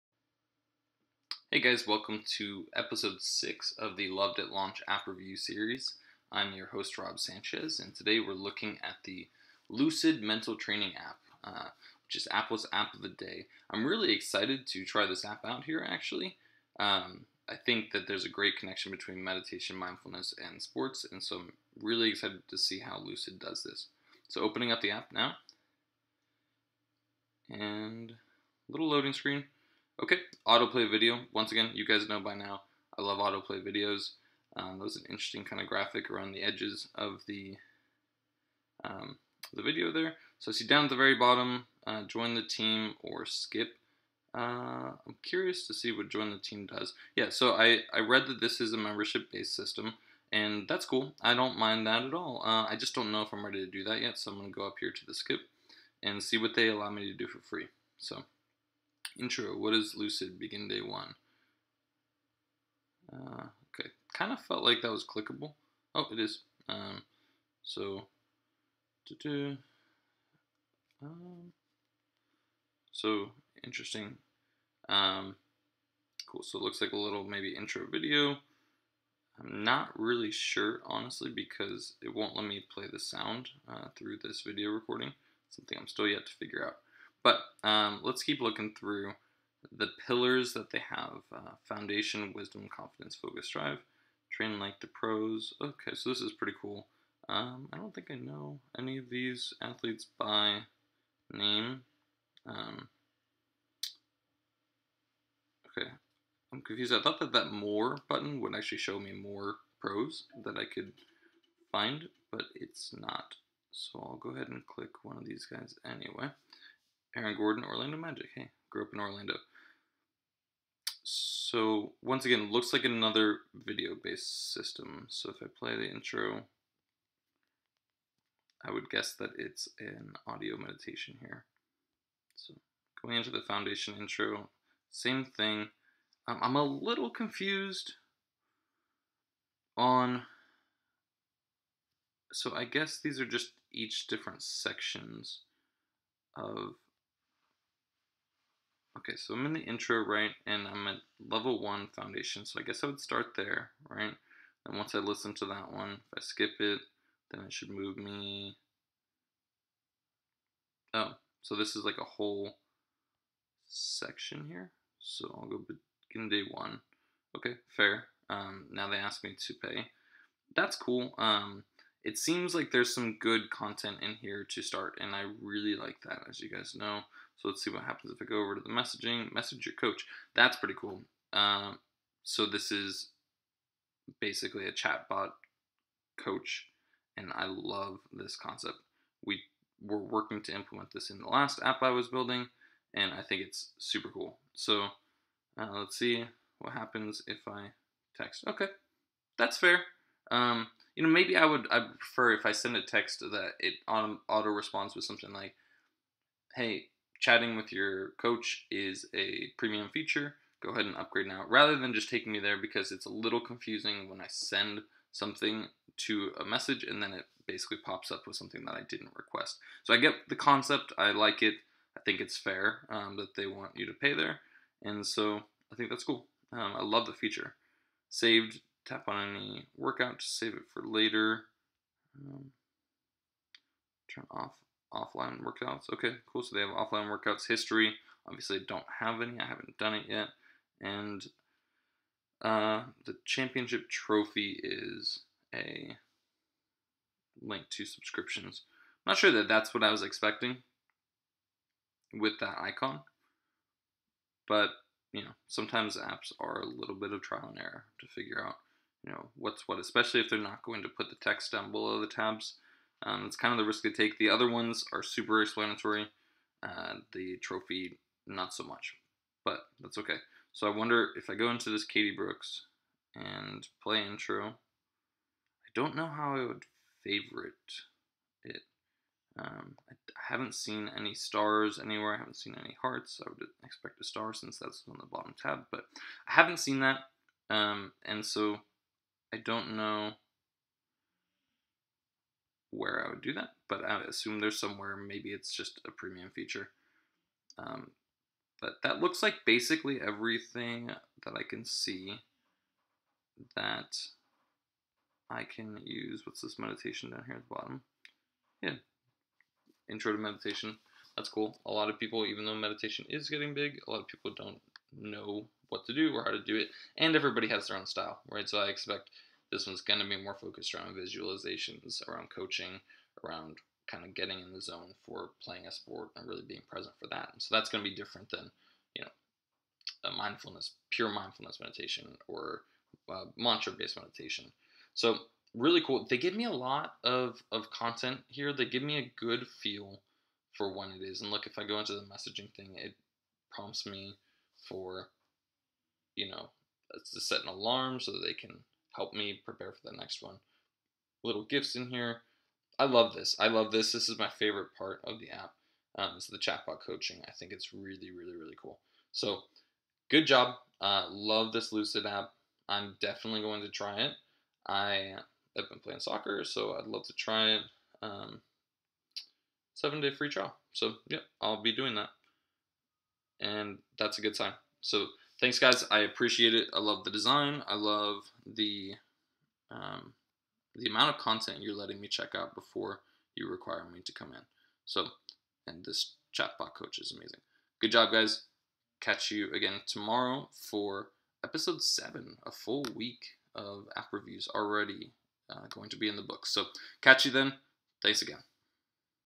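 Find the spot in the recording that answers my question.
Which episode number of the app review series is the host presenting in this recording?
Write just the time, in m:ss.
0:02.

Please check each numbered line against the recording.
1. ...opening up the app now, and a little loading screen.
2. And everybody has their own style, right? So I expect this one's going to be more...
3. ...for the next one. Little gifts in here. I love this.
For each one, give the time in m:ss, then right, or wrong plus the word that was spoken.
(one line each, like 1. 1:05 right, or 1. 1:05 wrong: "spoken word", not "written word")
1. 0:24 right
2. 5:16 right
3. 5:49 right.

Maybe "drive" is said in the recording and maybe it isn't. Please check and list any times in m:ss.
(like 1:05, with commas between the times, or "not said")
1:33.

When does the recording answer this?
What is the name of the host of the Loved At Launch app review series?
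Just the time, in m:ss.
0:06.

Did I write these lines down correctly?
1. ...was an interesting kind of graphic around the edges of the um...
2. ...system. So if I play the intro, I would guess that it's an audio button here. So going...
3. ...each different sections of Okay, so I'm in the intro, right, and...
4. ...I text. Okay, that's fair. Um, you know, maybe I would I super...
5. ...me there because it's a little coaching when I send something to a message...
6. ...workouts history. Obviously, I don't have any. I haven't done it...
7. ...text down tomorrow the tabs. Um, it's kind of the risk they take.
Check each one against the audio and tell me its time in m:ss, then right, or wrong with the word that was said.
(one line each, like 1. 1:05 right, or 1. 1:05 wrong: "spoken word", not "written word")
1. 0:34 right
2. 2:04 wrong: "meditation", not "button"
3. 2:23 right
4. 3:17 wrong: "prefer", not "super"
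5. 3:32 wrong: "confusing", not "coaching"
6. 3:57 right
7. 4:21 wrong: "below", not "tomorrow".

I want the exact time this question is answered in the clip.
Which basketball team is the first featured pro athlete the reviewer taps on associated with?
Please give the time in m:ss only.
1:57.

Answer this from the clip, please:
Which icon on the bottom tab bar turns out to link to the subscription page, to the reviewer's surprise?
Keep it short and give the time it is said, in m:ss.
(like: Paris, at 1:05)
Championship trophy, at 4:03.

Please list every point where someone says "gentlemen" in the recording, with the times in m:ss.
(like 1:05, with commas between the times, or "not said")
not said.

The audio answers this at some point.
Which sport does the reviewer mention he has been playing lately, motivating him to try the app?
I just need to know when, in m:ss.
6:05.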